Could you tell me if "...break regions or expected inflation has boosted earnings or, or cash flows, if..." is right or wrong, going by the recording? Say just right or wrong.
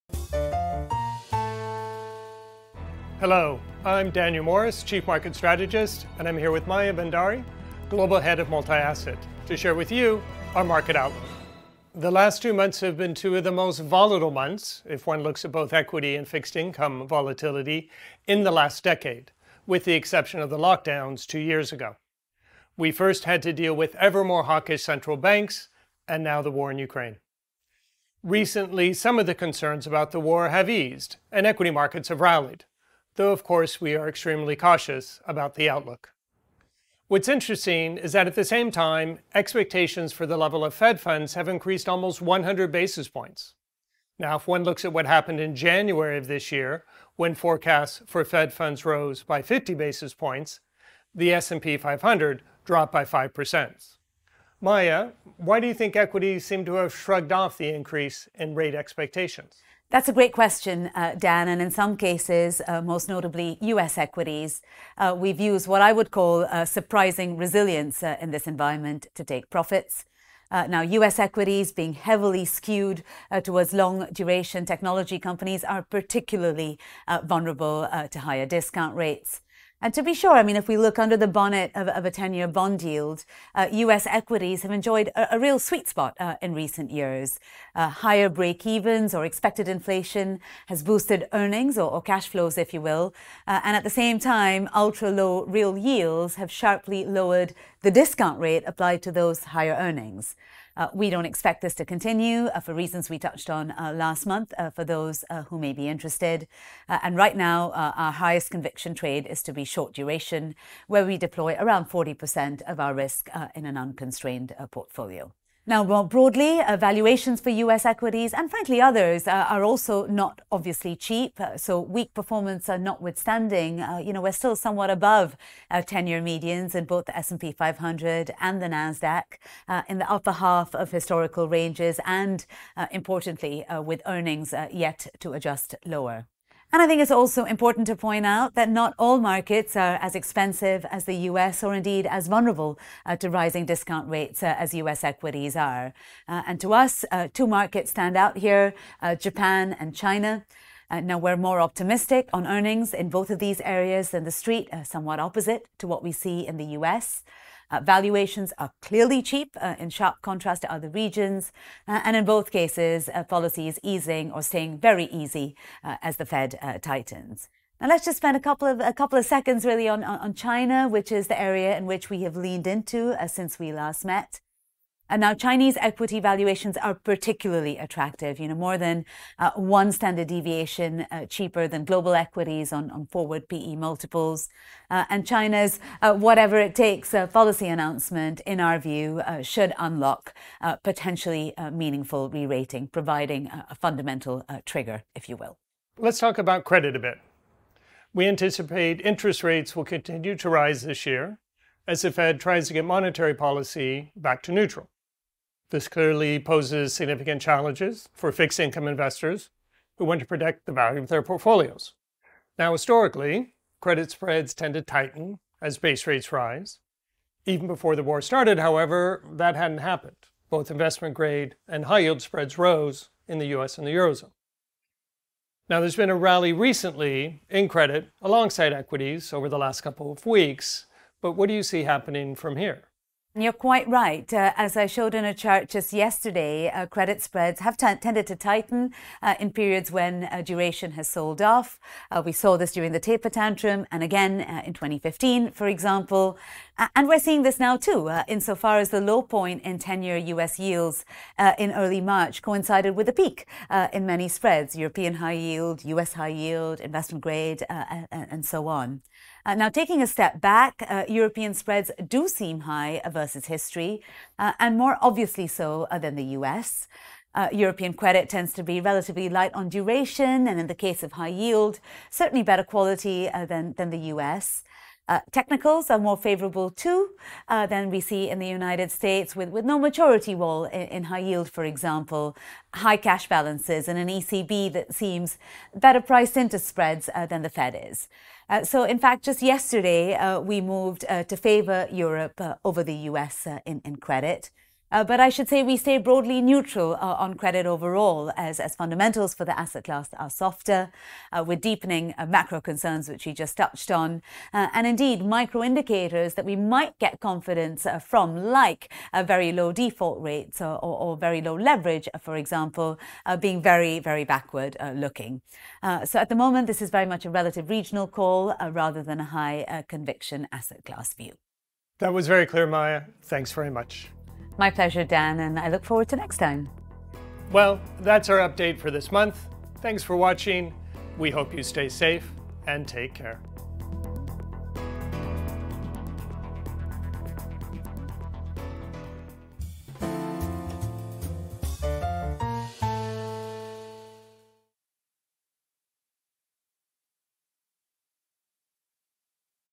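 wrong.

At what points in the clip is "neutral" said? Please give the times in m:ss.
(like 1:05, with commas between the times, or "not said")
3:24, 4:56.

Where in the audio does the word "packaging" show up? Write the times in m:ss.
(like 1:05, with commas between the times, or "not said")
not said.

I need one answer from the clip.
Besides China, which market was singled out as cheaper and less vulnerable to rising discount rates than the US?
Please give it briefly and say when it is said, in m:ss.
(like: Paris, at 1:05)
Japan, at 2:29.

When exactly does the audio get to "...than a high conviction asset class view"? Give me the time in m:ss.
5:19.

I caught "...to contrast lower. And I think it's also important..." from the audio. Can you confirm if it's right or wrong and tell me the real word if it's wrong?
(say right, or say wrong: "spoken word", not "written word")
wrong: "adjust", not "contrast".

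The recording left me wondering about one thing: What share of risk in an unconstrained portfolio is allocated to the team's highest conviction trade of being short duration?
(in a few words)
40%.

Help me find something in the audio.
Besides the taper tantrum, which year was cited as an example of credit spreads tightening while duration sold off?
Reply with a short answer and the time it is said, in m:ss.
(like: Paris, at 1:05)
2015, at 4:04.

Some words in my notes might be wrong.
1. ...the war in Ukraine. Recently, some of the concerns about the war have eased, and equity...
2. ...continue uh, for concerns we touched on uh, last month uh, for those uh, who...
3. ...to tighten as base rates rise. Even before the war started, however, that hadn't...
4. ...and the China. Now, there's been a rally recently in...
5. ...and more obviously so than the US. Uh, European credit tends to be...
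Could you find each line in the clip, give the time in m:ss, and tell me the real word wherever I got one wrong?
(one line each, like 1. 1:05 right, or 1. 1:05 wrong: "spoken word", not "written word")
1. 0:26 right
2. 1:41 wrong: "reasons", not "concerns"
3. 3:34 right
4. 3:43 wrong: "Eurozone", not "China"
5. 4:24 right.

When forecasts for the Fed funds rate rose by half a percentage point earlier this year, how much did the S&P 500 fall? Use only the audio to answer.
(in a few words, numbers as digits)
5%.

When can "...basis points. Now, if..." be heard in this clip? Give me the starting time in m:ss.
0:42.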